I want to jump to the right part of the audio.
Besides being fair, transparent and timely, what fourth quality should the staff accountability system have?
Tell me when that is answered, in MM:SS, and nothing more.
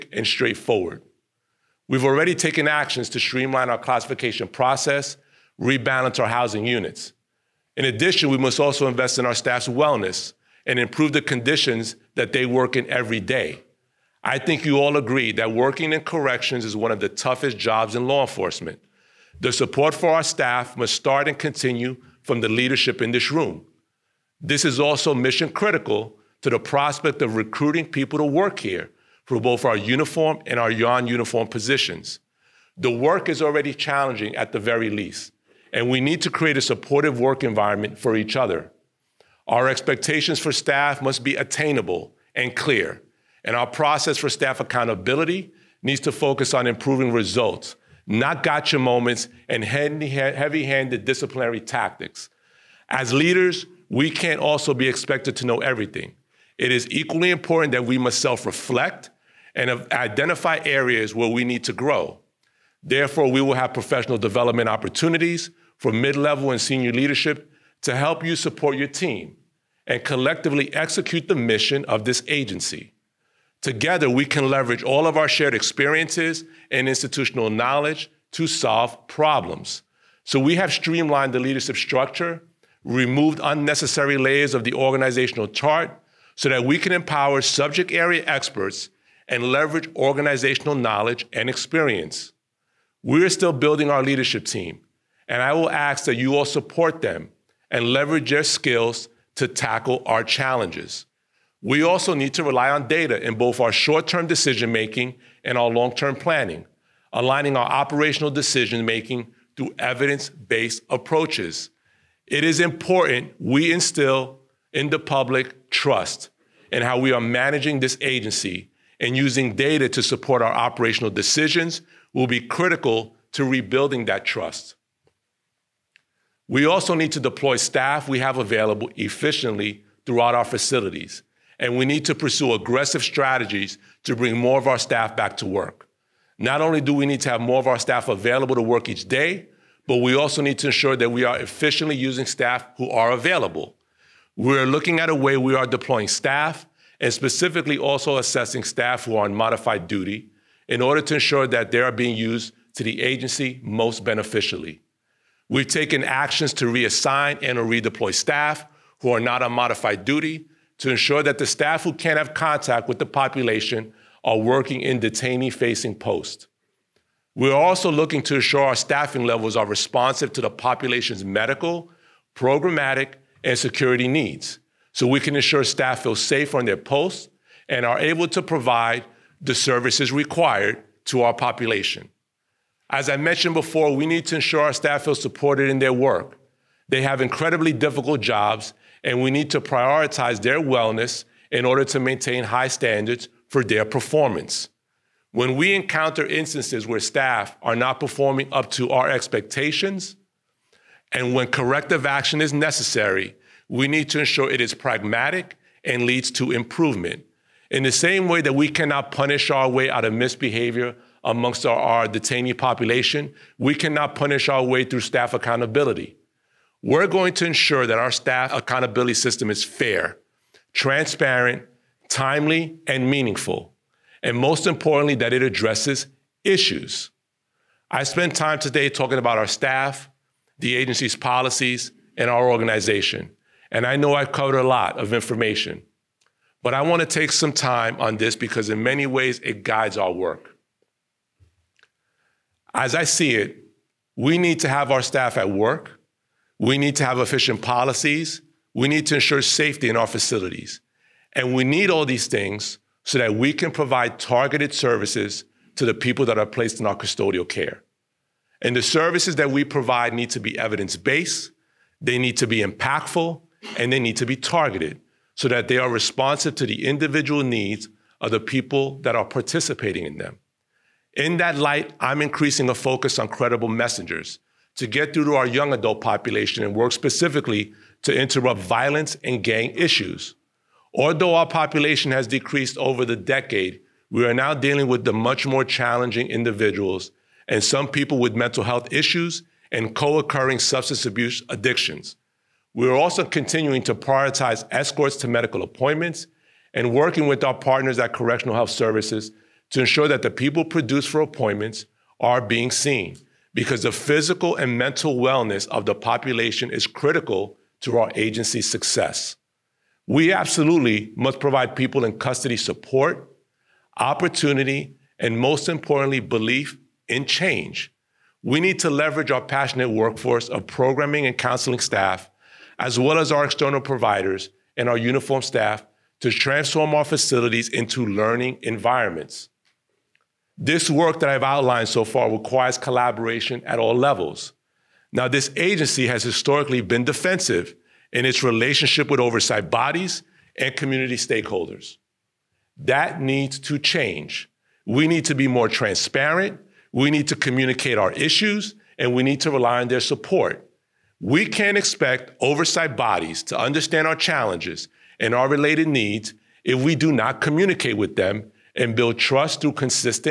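03:43.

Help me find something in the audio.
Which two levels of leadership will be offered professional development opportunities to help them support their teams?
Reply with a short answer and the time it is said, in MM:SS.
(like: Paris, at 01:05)
Mid level and senior leadership, at 01:05.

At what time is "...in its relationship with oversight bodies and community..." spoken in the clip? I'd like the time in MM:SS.
05:38.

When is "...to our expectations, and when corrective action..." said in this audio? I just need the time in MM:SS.
03:18.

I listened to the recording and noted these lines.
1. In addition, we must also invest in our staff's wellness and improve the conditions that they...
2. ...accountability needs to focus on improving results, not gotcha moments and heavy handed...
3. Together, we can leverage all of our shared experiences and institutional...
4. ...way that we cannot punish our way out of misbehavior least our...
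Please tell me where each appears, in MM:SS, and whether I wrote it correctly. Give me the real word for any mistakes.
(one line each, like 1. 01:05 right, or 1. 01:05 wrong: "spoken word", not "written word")
1. 00:07 right
2. 00:44 right
3. 01:13 right
4. 03:28 wrong: "amongst", not "least".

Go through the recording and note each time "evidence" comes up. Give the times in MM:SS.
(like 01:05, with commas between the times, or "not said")
01:49, 04:20.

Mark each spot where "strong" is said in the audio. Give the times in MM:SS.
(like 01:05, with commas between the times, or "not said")
not said.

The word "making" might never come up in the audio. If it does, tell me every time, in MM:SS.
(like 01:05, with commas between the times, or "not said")
01:44, 01:48.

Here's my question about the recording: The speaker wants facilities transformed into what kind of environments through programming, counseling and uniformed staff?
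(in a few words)
Learning environments.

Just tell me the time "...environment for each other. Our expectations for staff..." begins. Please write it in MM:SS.
00:37.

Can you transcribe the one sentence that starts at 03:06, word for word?
They have incredibly difficult jobs and we need to prioritize their wellness in order to maintain high standards for their performance.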